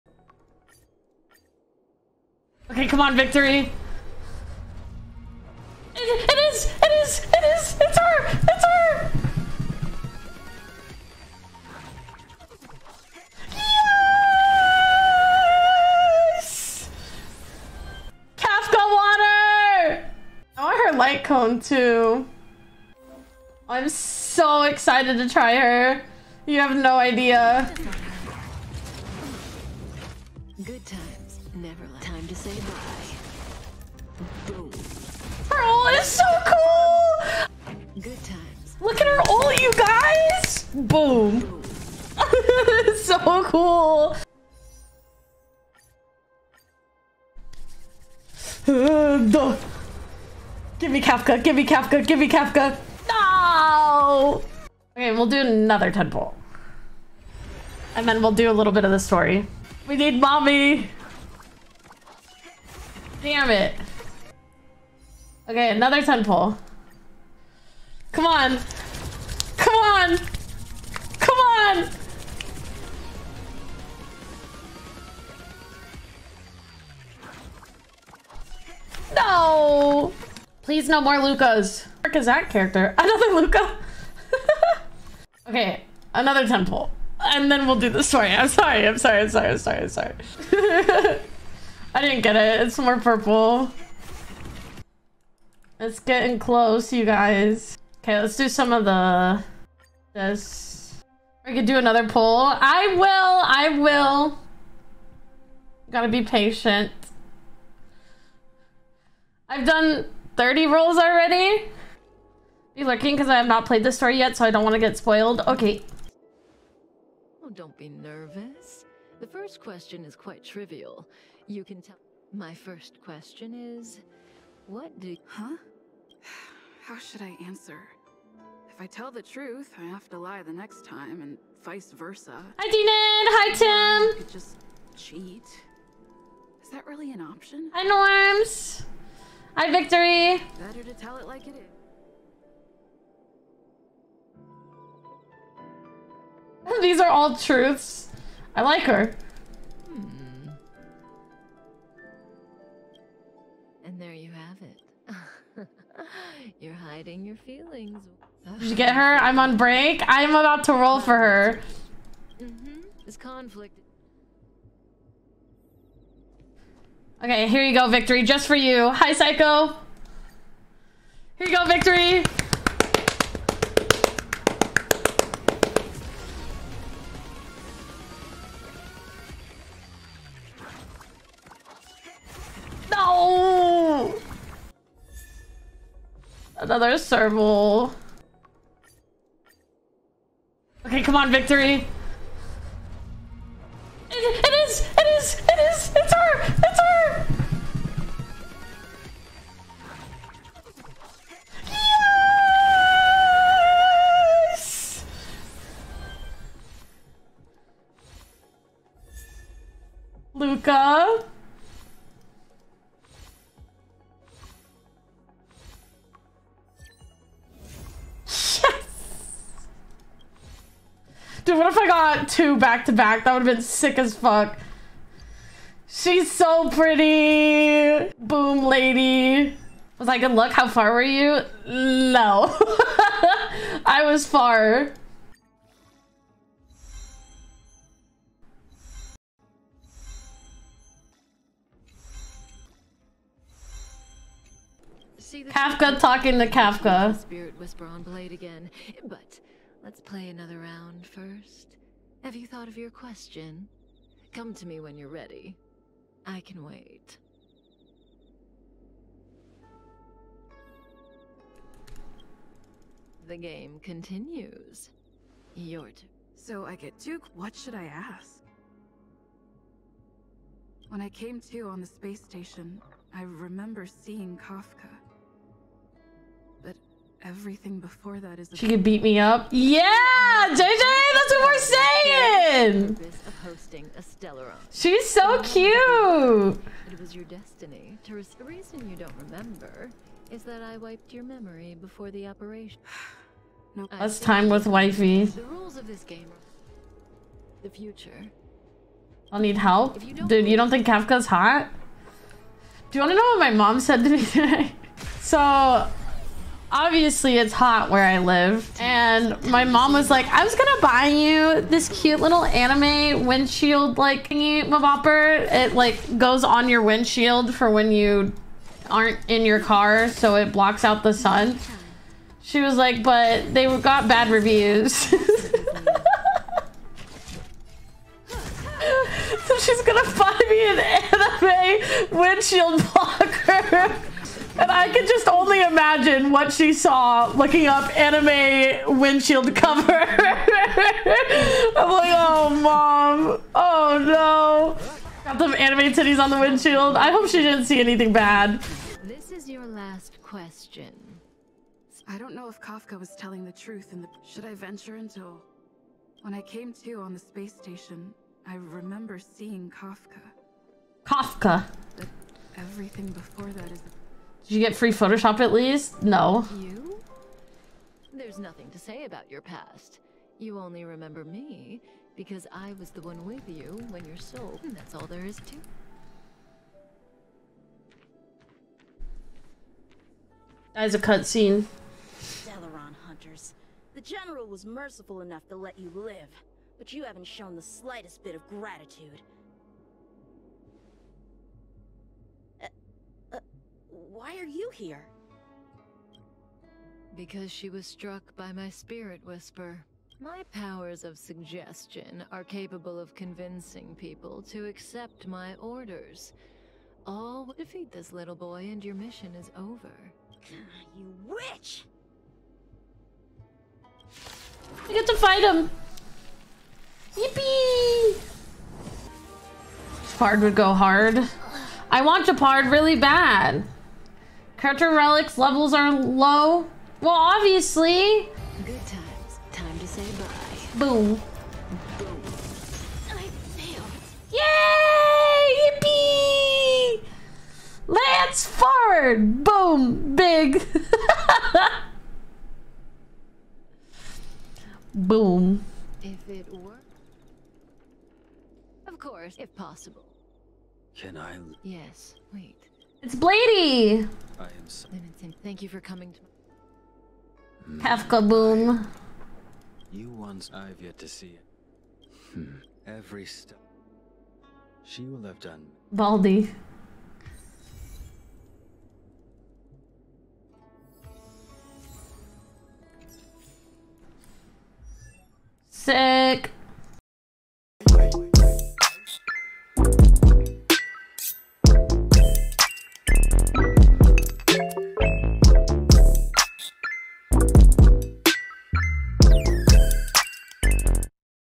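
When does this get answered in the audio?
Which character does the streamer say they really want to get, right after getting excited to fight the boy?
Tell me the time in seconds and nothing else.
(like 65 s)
422 s.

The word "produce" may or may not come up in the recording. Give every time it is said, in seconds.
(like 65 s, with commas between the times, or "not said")
not said.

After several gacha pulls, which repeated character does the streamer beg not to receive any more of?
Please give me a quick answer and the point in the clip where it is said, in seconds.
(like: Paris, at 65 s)
Luka, at 81 s.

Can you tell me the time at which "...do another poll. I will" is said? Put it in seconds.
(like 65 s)
101 s.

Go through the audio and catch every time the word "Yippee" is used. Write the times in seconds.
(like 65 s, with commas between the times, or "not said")
417 s, 436 s.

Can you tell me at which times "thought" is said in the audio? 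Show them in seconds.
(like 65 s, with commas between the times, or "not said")
252 s.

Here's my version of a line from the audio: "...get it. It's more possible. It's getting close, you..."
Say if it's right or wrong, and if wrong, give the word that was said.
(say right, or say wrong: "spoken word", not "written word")
wrong: "purple", not "possible".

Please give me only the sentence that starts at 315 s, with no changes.
It like goes on your windshield for when you aren't in your car, so it blocks out the sun.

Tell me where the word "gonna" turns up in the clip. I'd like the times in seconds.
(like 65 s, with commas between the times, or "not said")
310 s, 329 s.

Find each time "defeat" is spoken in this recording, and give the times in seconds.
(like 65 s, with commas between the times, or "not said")
407 s.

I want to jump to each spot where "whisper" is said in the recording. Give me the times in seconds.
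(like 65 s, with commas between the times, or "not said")
247 s, 399 s.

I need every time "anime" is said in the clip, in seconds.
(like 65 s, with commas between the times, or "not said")
312 s, 330 s, 337 s, 345 s.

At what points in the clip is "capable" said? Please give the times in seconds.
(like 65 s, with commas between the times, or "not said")
402 s.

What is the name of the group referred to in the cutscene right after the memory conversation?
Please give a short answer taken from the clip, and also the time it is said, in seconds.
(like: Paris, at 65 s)
Stellaron Hunters, at 382 s.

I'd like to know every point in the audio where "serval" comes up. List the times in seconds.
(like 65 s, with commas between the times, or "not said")
186 s.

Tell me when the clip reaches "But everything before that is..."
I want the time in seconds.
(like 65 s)
361 s.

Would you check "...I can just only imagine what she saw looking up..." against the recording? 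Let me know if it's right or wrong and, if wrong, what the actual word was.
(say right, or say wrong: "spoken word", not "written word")
right.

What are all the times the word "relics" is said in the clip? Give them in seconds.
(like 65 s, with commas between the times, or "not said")
424 s.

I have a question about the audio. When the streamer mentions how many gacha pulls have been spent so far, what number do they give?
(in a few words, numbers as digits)
30.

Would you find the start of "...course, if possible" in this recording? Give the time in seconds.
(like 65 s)
448 s.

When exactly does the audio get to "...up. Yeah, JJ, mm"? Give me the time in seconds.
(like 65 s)
279 s.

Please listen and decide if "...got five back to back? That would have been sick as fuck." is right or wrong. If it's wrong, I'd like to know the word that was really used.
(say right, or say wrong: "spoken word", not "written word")
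wrong: "two", not "five".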